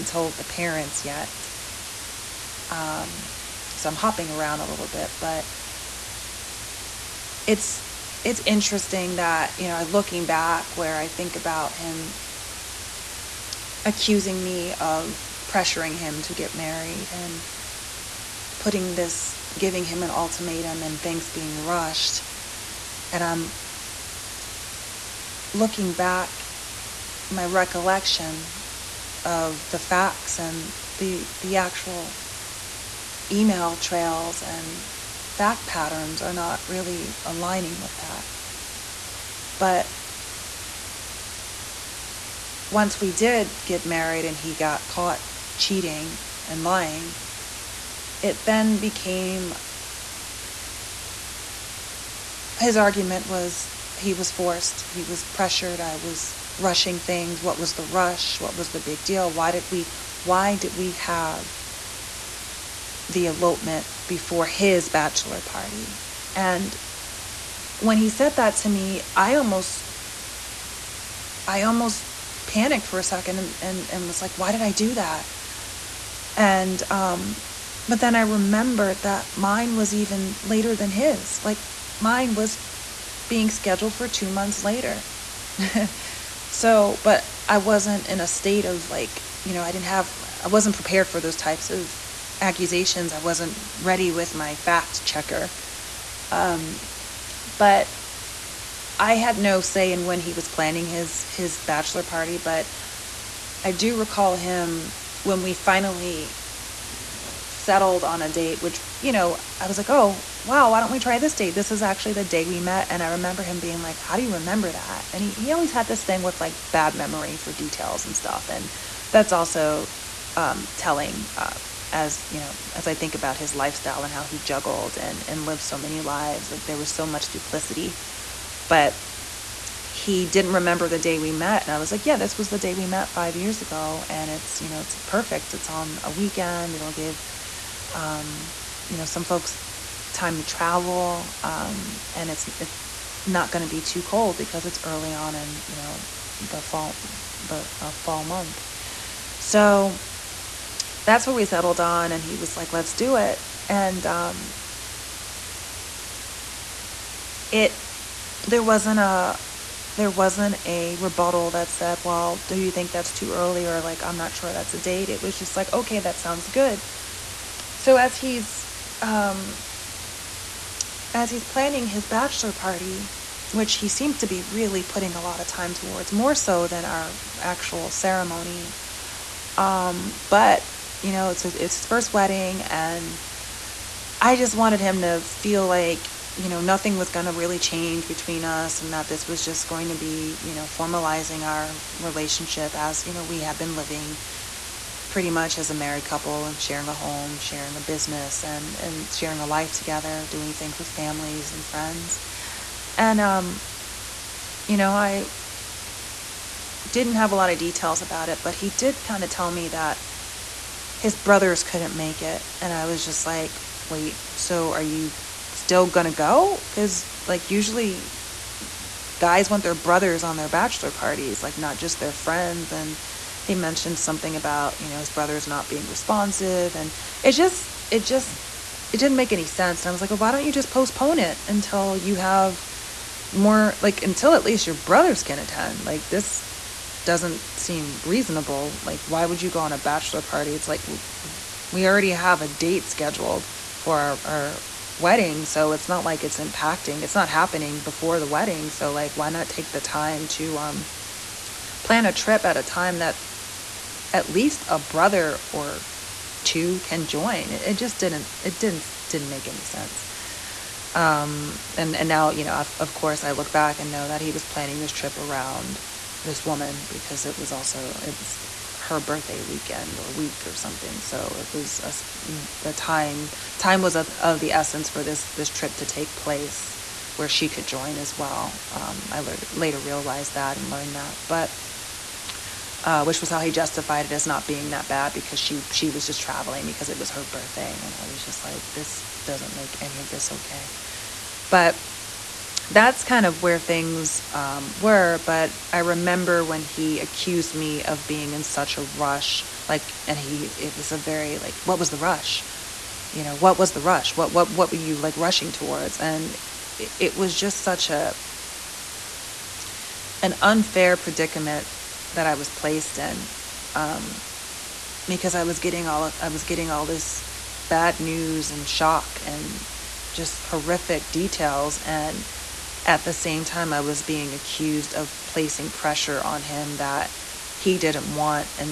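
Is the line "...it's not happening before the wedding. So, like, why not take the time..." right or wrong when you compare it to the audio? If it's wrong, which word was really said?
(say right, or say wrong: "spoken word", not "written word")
right.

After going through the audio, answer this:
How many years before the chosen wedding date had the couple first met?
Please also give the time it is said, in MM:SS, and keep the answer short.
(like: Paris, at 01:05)
5 years, at 02:13.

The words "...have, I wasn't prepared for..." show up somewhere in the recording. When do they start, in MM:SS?
01:29.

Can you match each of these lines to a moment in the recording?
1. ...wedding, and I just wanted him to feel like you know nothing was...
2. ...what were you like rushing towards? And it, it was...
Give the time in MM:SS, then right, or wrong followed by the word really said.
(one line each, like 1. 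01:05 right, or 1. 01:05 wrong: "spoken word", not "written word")
1. 03:02 right
2. 05:04 right.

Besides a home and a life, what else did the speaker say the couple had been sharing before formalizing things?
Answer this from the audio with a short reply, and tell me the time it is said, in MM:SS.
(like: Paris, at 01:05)
A business, at 03:17.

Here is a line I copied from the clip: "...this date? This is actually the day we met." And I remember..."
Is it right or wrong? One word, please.
right.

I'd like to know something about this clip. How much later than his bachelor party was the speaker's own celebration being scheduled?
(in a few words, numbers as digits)
2 months.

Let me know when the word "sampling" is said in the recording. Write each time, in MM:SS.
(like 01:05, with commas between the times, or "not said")
not said.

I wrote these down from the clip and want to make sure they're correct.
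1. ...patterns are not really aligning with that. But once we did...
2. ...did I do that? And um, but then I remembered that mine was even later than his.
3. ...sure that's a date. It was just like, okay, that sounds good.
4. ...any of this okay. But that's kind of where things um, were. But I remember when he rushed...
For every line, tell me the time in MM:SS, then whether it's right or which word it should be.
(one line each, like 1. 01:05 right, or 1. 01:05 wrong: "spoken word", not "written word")
1. 00:35 right
2. 01:14 right
3. 02:44 right
4. 04:49 wrong: "accused", not "rushed".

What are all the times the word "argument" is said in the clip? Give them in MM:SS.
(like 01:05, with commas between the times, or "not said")
00:52.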